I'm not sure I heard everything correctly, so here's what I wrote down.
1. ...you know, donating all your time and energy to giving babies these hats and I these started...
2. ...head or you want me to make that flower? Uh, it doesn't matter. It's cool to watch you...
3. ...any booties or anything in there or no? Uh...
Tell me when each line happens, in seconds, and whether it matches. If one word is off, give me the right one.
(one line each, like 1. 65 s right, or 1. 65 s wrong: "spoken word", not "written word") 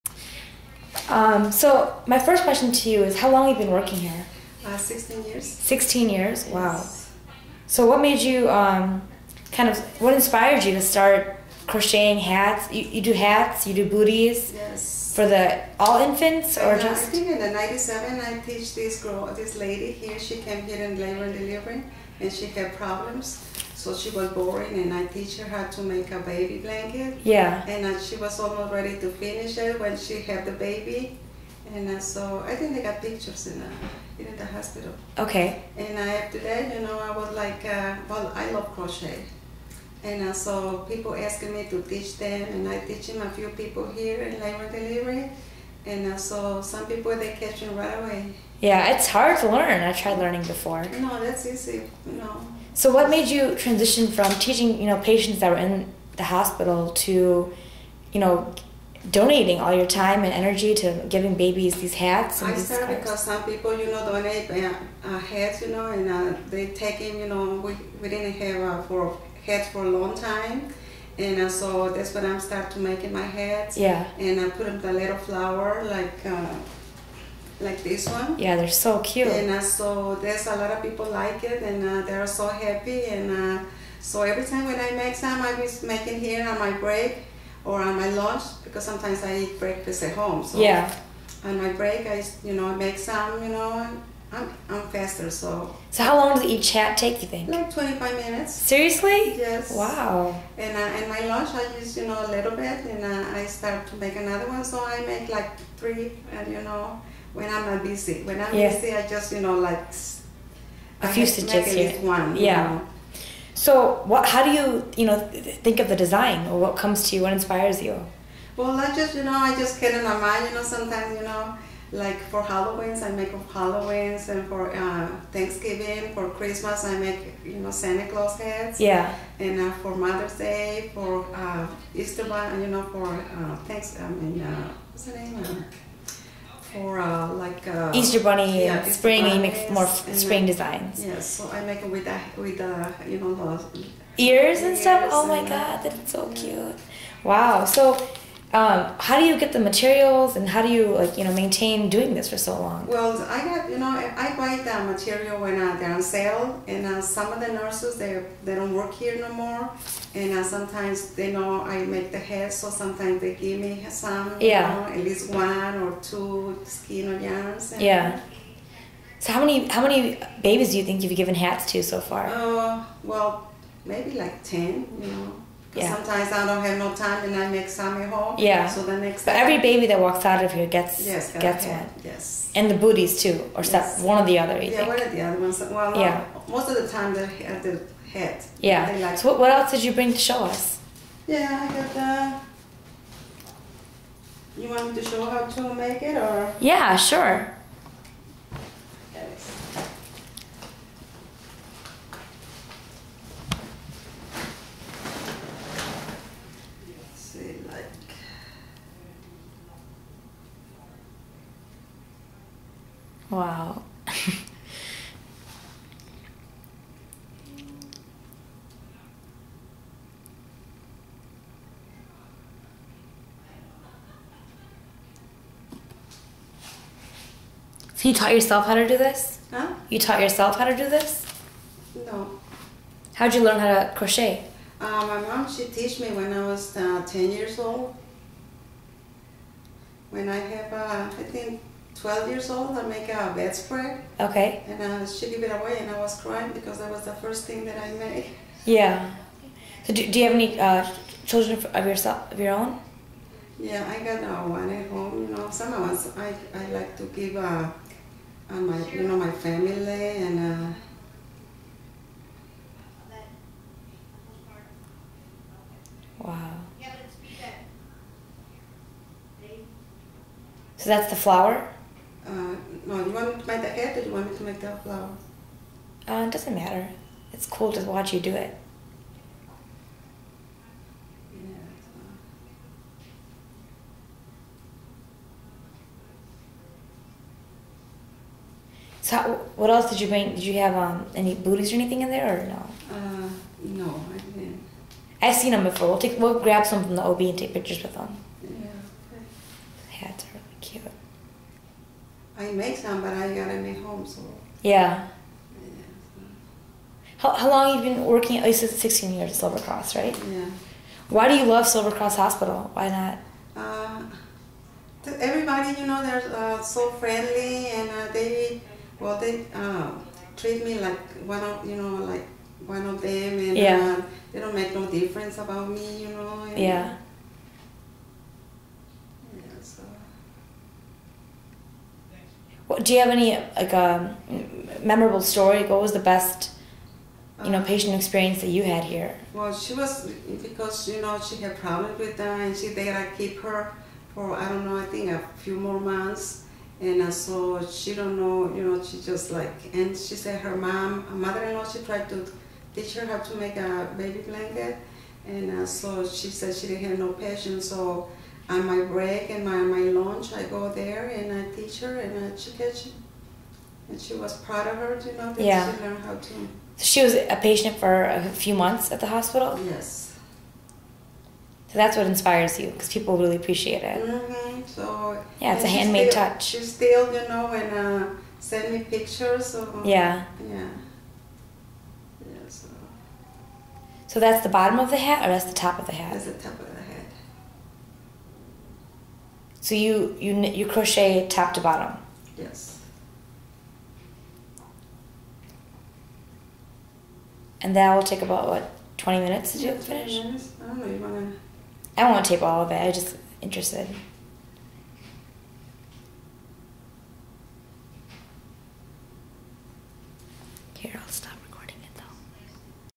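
1. 58 s right
2. 273 s right
3. 291 s right.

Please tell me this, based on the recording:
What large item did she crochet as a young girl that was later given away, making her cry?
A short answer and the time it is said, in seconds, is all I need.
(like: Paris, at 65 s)
A bedspread, at 243 s.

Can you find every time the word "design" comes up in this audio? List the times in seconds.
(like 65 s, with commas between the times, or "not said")
115 s, 140 s.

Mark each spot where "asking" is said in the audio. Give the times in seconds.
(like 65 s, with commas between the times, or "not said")
41 s.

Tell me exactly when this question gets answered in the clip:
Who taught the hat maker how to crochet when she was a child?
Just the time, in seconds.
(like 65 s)
235 s.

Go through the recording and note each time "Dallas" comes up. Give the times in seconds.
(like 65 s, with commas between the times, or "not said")
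not said.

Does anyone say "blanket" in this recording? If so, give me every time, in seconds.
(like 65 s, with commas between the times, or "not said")
26 s, 354 s.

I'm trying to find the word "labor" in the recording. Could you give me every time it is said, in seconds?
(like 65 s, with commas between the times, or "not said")
20 s, 44 s.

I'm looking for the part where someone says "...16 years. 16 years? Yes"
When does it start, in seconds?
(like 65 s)
4 s.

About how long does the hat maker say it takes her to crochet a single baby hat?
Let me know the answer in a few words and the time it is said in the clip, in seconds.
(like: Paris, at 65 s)
25 minutes, at 97 s.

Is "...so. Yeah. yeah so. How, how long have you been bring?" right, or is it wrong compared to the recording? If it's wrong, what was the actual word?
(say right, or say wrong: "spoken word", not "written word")
wrong: "working", not "bring".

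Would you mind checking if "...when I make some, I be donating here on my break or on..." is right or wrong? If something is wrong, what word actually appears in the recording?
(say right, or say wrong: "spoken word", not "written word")
wrong: "making", not "donating".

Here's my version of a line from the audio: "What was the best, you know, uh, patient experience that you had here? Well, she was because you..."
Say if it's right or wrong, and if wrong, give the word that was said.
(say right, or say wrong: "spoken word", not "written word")
right.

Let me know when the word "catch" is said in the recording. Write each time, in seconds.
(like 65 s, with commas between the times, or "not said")
47 s, 362 s.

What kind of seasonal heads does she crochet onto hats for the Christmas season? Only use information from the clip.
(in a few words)
Santa Claus.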